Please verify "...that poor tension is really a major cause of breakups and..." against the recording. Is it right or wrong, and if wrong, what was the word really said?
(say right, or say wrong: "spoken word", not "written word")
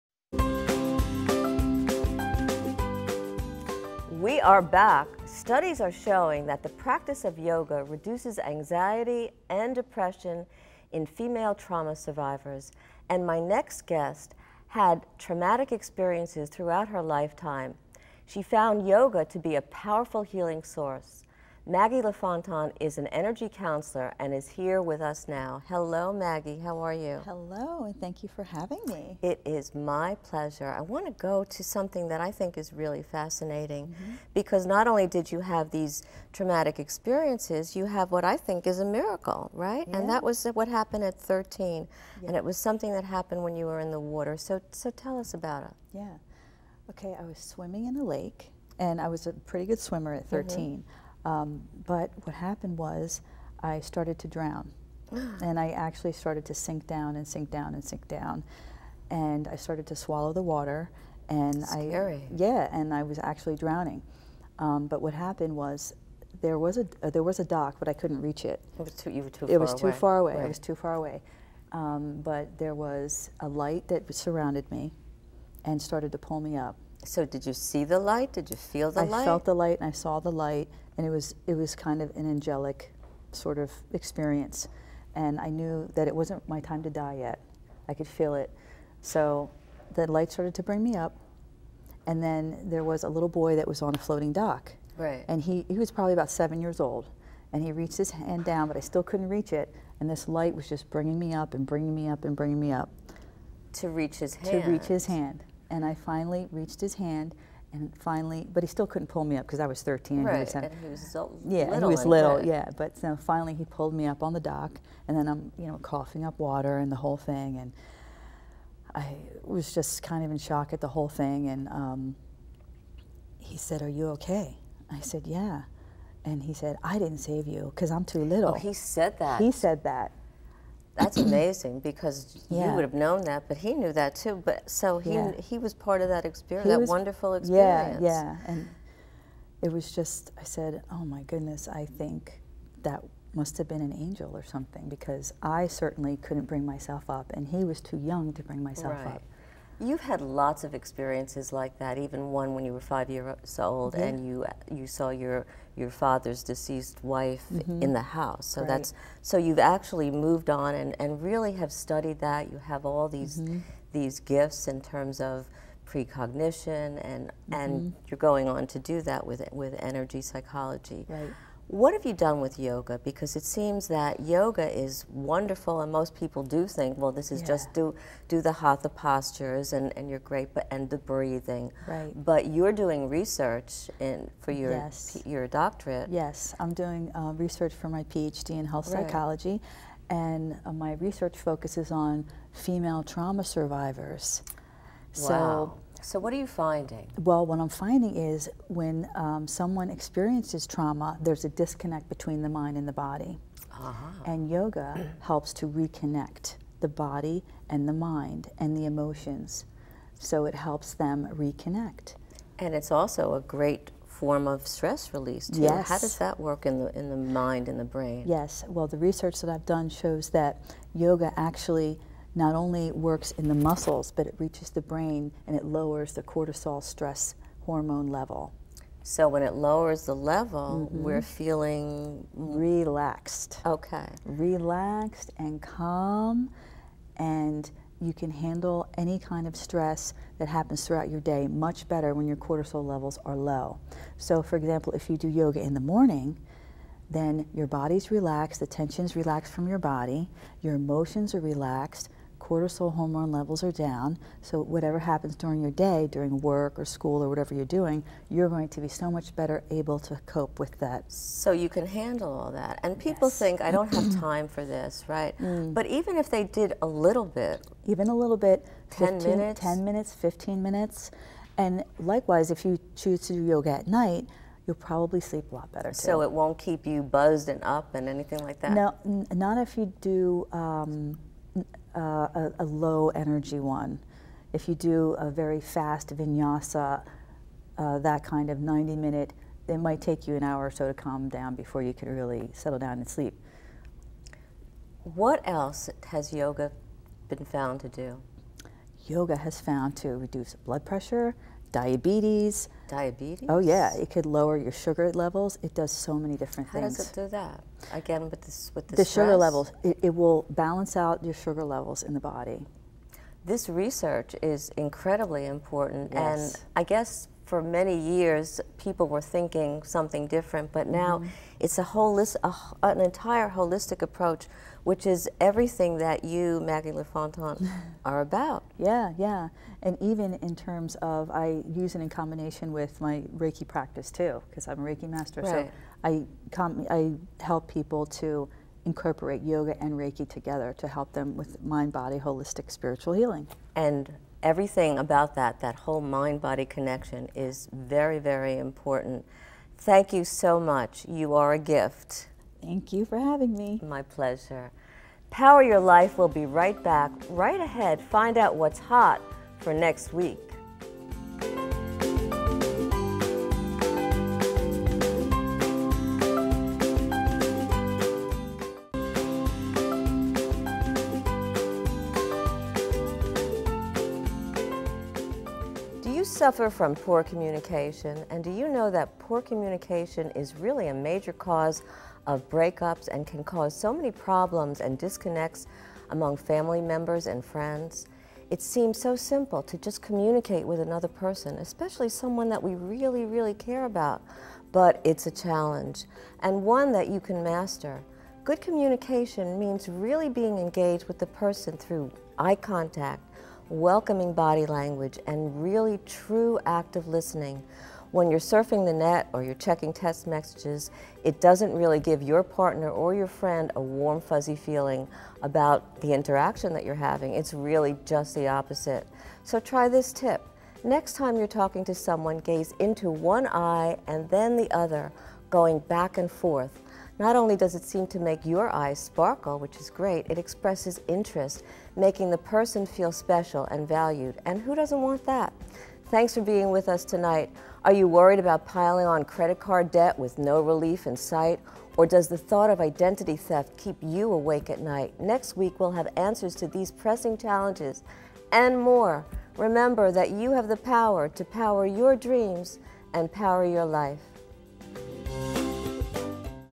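wrong: "communication", not "tension".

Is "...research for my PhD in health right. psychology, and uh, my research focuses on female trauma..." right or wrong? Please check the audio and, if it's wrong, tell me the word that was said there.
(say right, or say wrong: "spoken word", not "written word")
right.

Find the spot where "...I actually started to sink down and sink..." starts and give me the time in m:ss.
0:55.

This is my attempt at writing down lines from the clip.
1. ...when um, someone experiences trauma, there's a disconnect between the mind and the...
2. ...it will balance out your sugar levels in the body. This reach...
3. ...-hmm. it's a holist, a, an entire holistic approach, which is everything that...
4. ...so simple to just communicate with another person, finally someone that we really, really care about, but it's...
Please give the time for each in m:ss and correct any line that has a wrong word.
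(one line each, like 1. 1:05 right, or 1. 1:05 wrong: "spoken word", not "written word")
1. 3:18 right
2. 5:10 wrong: "research", not "reach"
3. 5:21 right
4. 6:28 wrong: "especially", not "finally".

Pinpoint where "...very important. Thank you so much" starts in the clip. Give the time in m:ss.
5:48.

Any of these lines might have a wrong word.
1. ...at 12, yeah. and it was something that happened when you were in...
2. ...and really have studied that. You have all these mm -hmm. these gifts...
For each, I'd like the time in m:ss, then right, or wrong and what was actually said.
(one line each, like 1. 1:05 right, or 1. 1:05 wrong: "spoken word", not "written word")
1. 0:41 wrong: "13", not "12"
2. 2:41 right.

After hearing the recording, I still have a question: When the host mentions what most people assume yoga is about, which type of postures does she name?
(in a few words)
hatha.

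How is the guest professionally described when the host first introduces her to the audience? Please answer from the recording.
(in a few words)
energy counselor.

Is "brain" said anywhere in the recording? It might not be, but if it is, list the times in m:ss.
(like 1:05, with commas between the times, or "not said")
3:37, 3:44.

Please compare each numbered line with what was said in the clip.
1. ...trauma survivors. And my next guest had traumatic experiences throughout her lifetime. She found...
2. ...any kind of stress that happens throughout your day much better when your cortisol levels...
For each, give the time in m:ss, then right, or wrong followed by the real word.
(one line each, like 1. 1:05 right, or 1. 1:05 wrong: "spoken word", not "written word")
1. 0:11 right
2. 3:58 right.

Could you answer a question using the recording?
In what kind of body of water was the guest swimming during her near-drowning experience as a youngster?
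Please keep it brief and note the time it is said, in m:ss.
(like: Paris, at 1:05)
a lake, at 0:48.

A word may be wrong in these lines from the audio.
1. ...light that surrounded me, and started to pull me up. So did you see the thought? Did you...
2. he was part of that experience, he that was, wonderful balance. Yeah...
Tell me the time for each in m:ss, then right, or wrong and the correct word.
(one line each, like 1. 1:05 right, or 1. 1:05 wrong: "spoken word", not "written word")
1. 1:13 wrong: "light", not "thought"
2. 2:15 wrong: "experience", not "balance".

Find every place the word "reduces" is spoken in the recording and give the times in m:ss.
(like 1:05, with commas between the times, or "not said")
0:07, 5:00.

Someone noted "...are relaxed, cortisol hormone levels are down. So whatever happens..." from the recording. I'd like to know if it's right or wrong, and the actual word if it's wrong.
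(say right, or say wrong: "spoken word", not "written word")
right.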